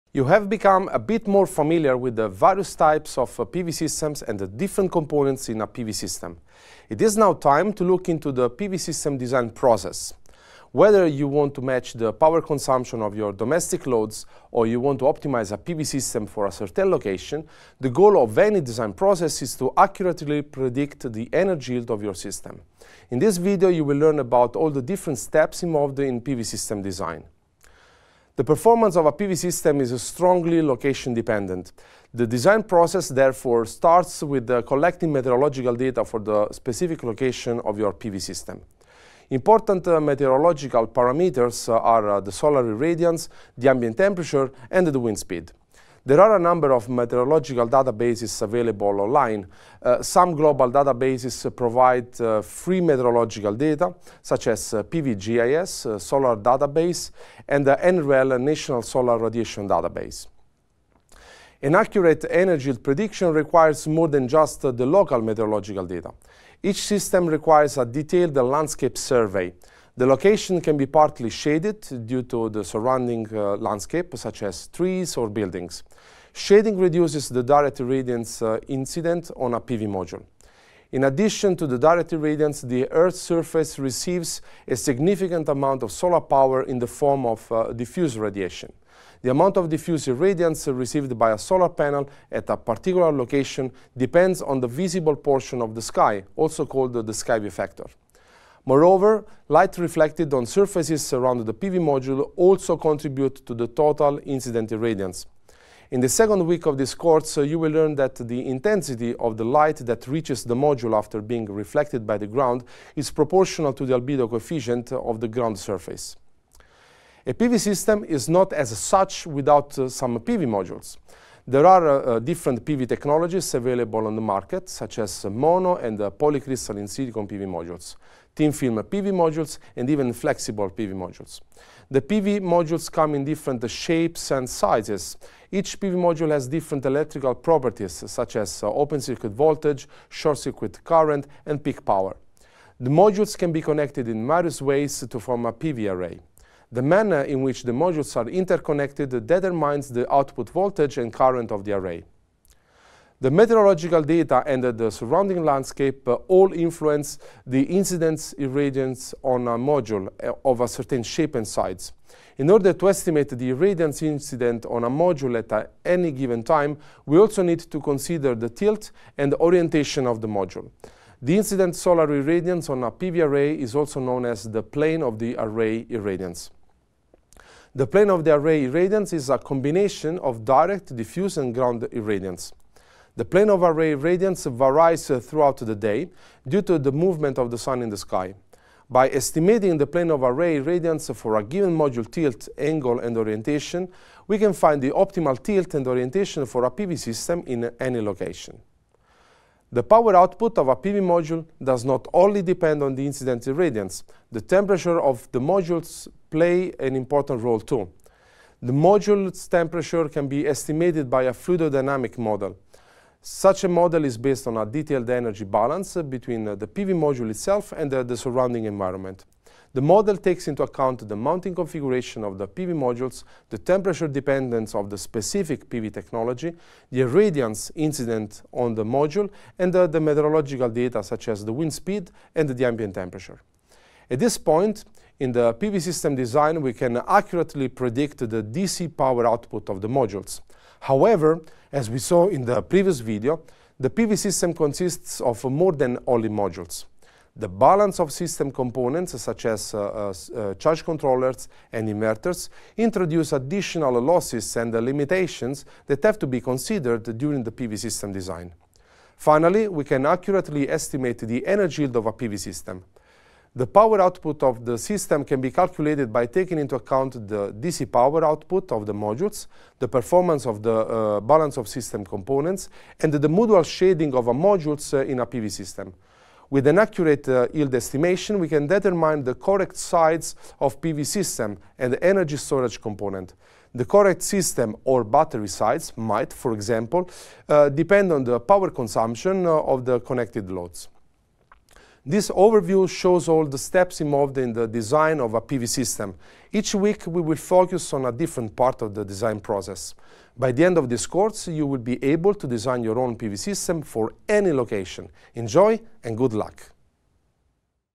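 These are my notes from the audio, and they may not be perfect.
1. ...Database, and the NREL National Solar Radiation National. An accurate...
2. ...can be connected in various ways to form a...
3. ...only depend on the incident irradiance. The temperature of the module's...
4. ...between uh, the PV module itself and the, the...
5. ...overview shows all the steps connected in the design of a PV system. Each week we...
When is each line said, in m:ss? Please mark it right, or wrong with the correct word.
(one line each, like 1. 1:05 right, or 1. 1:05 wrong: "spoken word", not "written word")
1. 0:56 wrong: "Database", not "National"
2. 2:23 right
3. 3:22 right
4. 3:36 right
5. 4:52 wrong: "involved", not "connected".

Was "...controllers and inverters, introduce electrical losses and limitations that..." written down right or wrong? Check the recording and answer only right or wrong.
wrong.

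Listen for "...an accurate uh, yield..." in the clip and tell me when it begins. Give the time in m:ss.
4:36.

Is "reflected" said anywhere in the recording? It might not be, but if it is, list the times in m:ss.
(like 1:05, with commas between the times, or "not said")
1:39, 1:51.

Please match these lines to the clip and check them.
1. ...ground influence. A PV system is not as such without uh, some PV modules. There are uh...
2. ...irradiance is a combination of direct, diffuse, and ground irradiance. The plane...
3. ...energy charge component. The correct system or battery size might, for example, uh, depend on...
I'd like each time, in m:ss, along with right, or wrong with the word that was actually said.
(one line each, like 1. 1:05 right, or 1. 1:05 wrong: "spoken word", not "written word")
1. 1:55 wrong: "surface", not "influence"
2. 2:58 right
3. 4:42 wrong: "storage", not "charge".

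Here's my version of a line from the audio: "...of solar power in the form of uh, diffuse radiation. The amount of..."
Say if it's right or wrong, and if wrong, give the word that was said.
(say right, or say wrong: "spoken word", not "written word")
right.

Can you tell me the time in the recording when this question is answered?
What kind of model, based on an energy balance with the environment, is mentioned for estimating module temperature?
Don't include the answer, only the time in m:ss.
3:31.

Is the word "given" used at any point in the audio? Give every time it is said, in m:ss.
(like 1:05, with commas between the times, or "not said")
2:46, 3:11.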